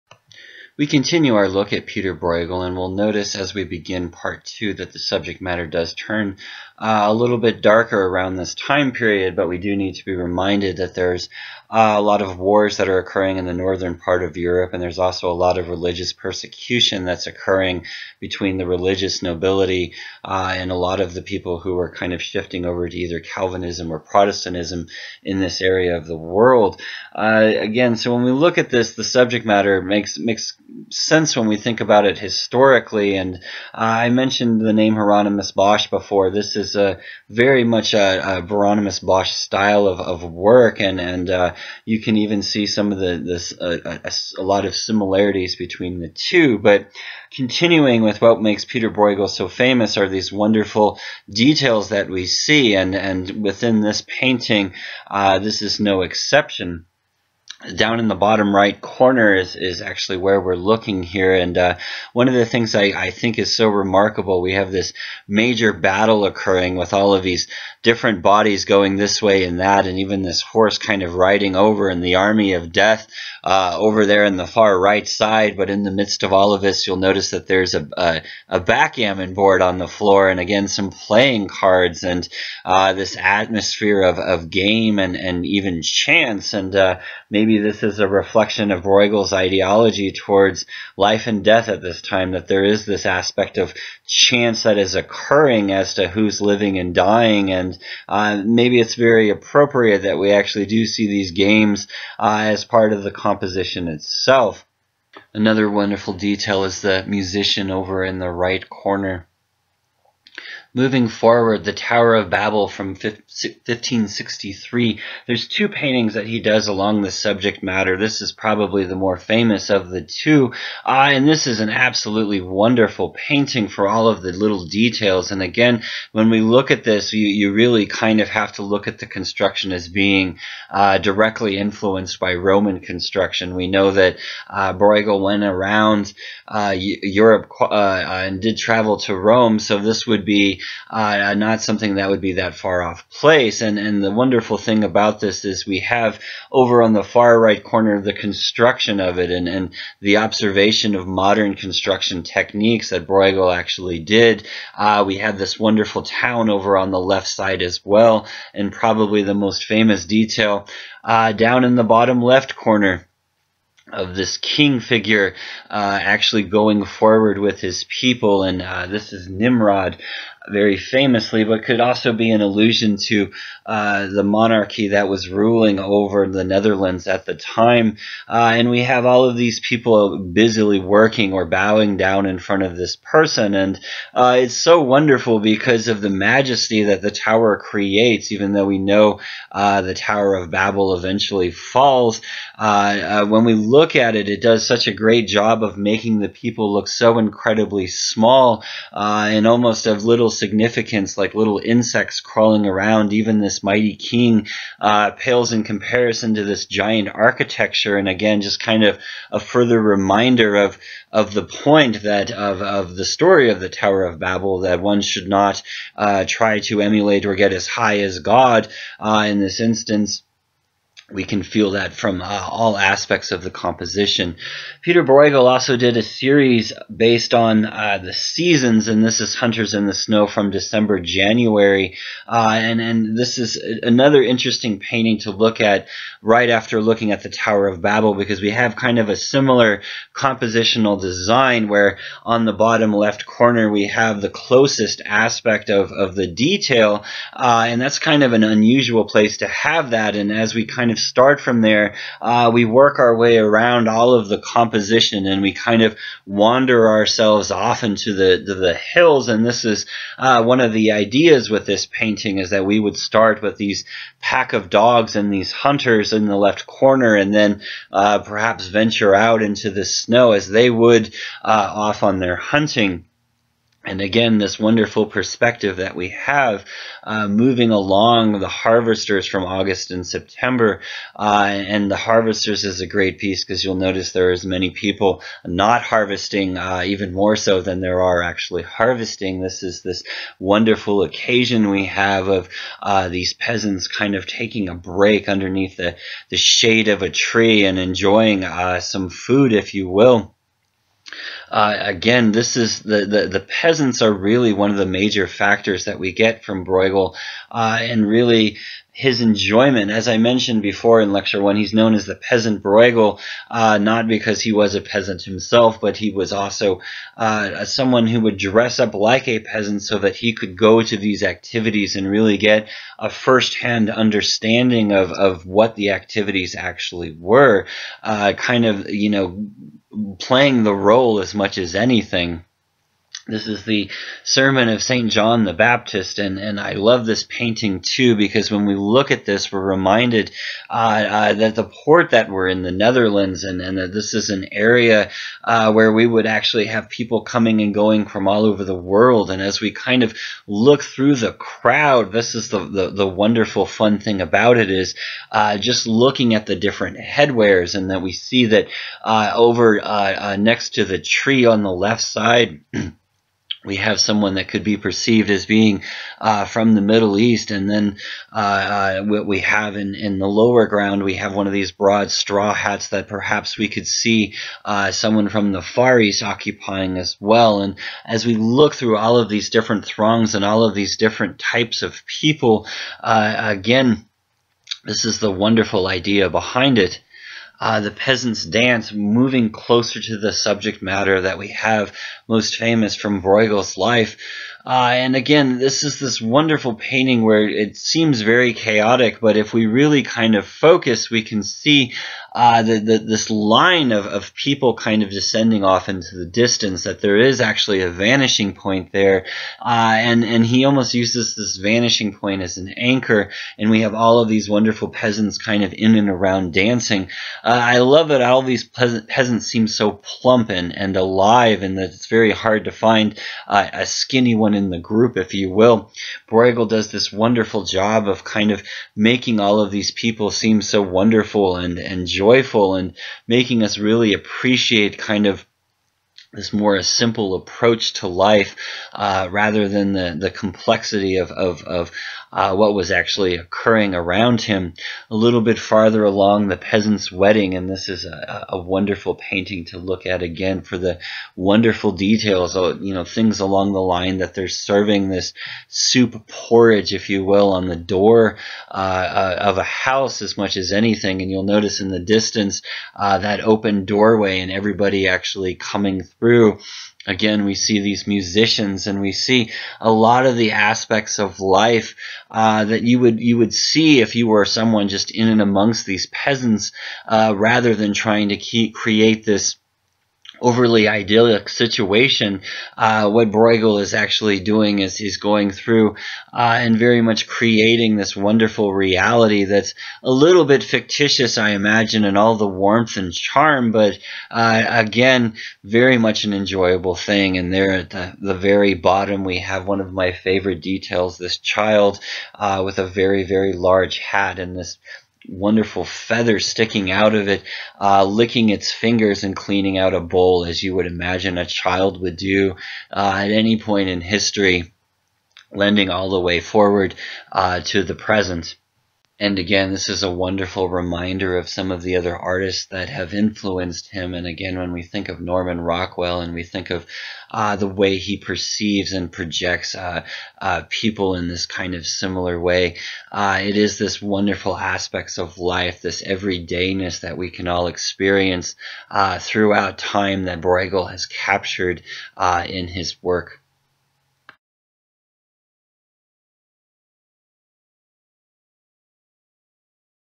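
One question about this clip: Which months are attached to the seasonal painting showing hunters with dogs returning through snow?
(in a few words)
December, January.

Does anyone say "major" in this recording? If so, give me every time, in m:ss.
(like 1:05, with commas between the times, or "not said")
1:05, 5:04.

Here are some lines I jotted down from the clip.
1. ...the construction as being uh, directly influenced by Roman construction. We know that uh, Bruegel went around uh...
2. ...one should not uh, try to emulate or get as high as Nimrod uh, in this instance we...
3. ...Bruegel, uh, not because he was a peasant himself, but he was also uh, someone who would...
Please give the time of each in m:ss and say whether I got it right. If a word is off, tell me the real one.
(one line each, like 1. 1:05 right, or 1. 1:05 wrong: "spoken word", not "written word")
1. 2:08 right
2. 3:34 wrong: "God", not "Nimrod"
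3. 5:12 right.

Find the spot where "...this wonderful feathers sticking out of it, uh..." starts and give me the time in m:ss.
8:24.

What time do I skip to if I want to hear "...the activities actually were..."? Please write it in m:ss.
5:25.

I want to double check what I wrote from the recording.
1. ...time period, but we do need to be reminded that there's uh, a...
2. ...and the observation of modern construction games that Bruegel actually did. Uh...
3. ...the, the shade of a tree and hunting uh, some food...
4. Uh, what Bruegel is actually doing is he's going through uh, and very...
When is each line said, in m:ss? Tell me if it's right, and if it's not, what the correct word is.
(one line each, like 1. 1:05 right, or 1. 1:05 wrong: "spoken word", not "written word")
1. 0:08 right
2. 2:29 wrong: "techniques", not "games"
3. 4:55 wrong: "enjoying", not "hunting"
4. 8:02 right.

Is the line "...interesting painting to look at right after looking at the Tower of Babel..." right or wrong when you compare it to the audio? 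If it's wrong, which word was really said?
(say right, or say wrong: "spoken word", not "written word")
right.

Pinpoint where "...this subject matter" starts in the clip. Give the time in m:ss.
1:57.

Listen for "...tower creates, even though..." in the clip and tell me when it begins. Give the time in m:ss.
3:07.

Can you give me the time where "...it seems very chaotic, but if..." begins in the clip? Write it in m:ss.
6:37.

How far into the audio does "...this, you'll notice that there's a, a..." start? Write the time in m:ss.
1:16.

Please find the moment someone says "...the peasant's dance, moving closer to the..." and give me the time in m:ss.
6:27.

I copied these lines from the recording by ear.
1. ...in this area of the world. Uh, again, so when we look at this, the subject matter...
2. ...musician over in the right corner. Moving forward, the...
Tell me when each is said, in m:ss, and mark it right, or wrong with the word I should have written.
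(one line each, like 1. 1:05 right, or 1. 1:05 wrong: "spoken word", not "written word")
1. 0:25 right
2. 1:47 right.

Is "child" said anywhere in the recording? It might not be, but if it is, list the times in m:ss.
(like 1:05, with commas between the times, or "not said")
8:21, 8:31.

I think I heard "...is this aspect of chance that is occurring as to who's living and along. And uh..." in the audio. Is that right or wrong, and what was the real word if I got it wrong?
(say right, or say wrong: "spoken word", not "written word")
wrong: "dying", not "along".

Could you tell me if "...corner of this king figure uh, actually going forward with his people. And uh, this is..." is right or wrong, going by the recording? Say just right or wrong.
right.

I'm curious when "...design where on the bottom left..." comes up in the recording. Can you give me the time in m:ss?
4:01.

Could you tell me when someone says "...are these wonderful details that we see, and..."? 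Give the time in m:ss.
0:49.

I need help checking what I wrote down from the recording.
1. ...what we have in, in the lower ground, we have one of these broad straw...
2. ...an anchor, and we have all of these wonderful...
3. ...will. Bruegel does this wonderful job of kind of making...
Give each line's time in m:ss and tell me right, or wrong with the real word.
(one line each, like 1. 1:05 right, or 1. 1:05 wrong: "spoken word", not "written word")
1. 6:09 right
2. 6:52 right
3. 7:05 right.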